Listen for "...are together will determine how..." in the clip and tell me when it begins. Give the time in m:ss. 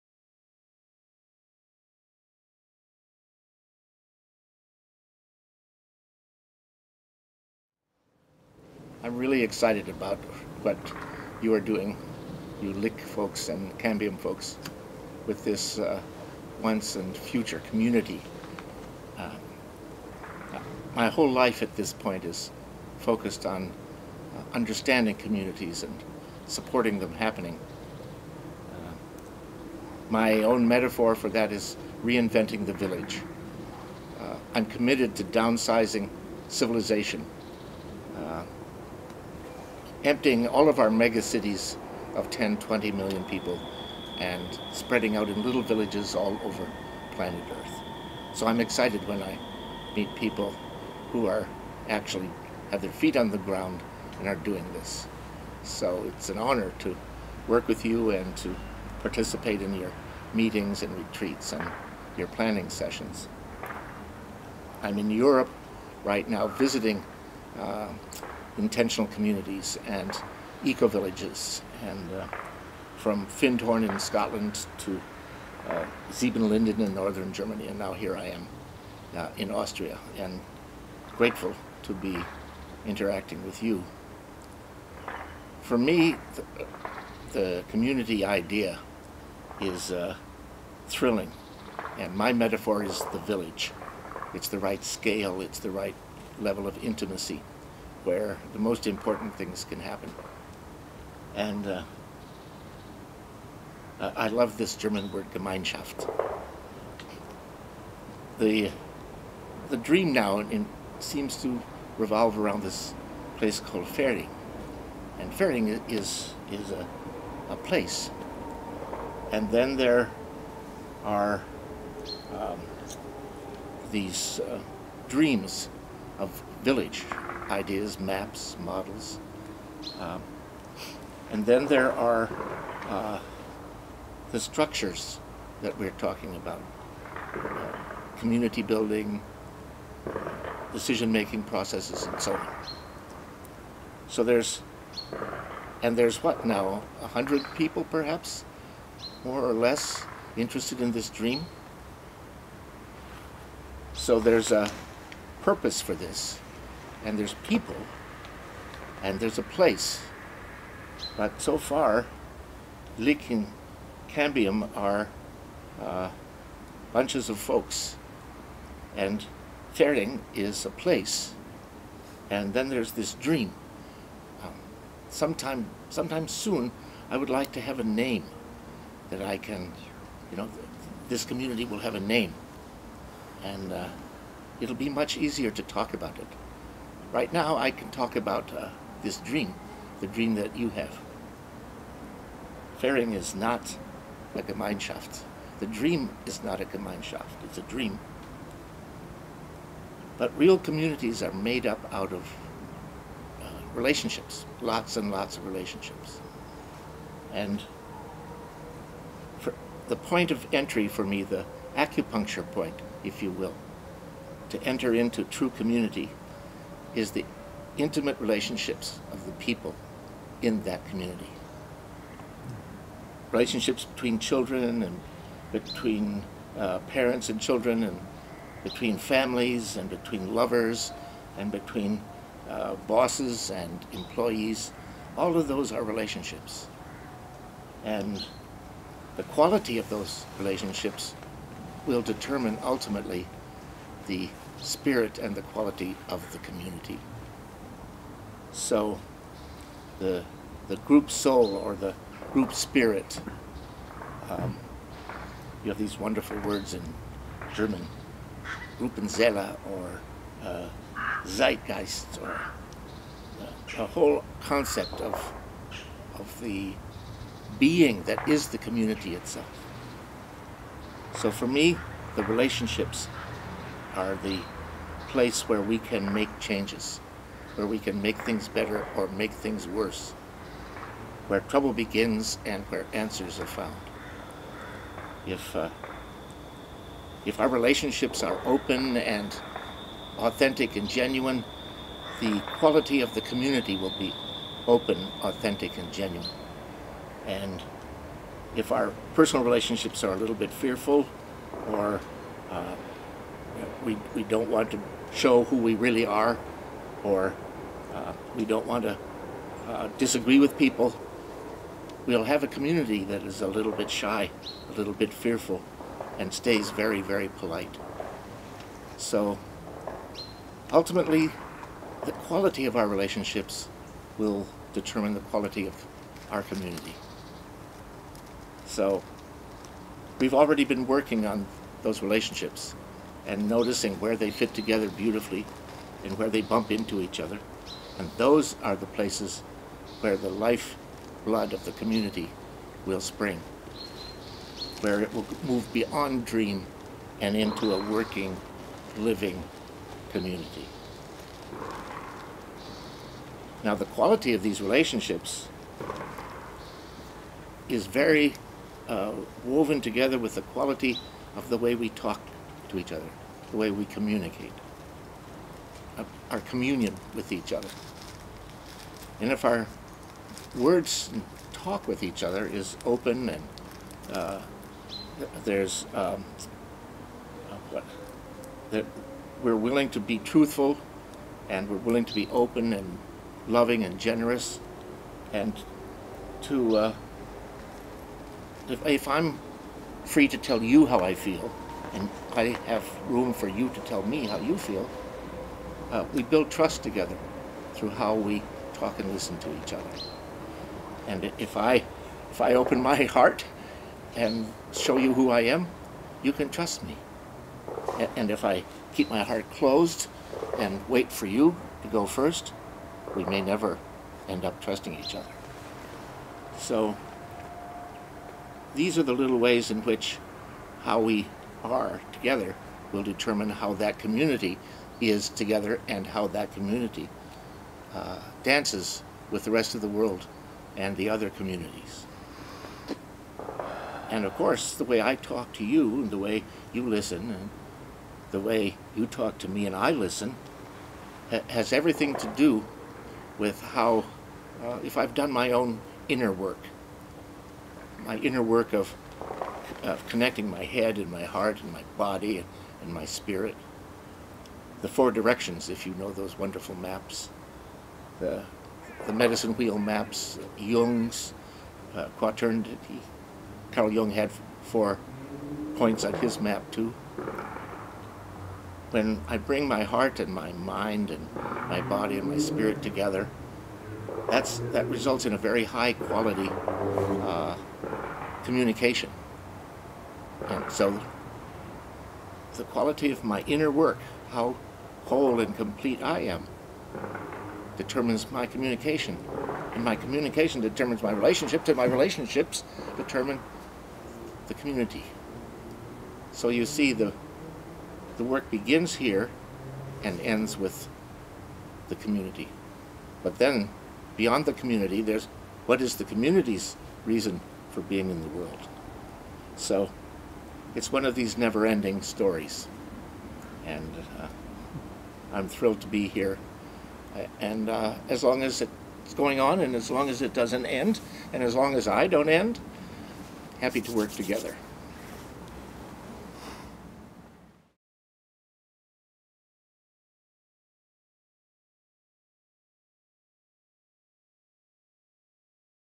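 7:01.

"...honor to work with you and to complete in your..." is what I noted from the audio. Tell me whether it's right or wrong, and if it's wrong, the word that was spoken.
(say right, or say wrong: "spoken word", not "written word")
wrong: "participate", not "complete".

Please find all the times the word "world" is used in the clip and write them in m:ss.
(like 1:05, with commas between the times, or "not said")
7:09, 8:28.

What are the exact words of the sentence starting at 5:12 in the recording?
We'll have a community that is a little bit shy, a little bit fearful, and stays very, very polite.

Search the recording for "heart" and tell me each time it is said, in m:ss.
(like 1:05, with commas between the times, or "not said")
6:43, 6:49, 7:31, 7:49.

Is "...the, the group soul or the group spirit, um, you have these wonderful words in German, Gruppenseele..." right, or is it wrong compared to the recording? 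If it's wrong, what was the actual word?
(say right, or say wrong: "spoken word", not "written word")
right.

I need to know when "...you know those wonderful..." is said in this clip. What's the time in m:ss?
7:35.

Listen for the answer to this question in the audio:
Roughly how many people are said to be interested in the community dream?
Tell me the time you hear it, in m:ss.
2:27.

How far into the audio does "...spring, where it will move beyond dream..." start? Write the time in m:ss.
5:43.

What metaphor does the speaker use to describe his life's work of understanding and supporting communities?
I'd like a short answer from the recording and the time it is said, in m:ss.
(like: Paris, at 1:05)
reinventing the village, at 0:32.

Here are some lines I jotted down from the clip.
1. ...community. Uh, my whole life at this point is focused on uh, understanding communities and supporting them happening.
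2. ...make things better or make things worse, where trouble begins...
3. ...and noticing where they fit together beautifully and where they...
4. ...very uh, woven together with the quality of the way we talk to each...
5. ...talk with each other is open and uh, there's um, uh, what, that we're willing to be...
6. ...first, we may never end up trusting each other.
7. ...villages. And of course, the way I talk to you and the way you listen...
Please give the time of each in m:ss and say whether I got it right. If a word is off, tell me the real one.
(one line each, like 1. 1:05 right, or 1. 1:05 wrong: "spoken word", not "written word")
1. 0:17 right
2. 4:38 right
3. 5:33 right
4. 5:57 right
5. 6:11 right
6. 6:52 right
7. 7:11 wrong: "communities", not "villages".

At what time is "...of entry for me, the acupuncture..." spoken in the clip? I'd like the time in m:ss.
3:30.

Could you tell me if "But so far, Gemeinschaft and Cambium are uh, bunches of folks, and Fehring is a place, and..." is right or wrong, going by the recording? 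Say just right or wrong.
wrong.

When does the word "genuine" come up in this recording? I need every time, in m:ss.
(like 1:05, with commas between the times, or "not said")
4:50, 4:55.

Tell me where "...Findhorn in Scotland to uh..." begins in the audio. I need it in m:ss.
1:13.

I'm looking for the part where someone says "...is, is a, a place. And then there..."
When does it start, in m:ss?
1:55.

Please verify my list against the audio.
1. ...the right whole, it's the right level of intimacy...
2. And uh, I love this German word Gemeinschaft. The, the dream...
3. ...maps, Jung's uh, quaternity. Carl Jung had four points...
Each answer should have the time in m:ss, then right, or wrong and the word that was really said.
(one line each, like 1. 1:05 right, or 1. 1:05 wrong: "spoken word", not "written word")
1. 1:34 wrong: "scale", not "whole"
2. 1:41 right
3. 7:39 right.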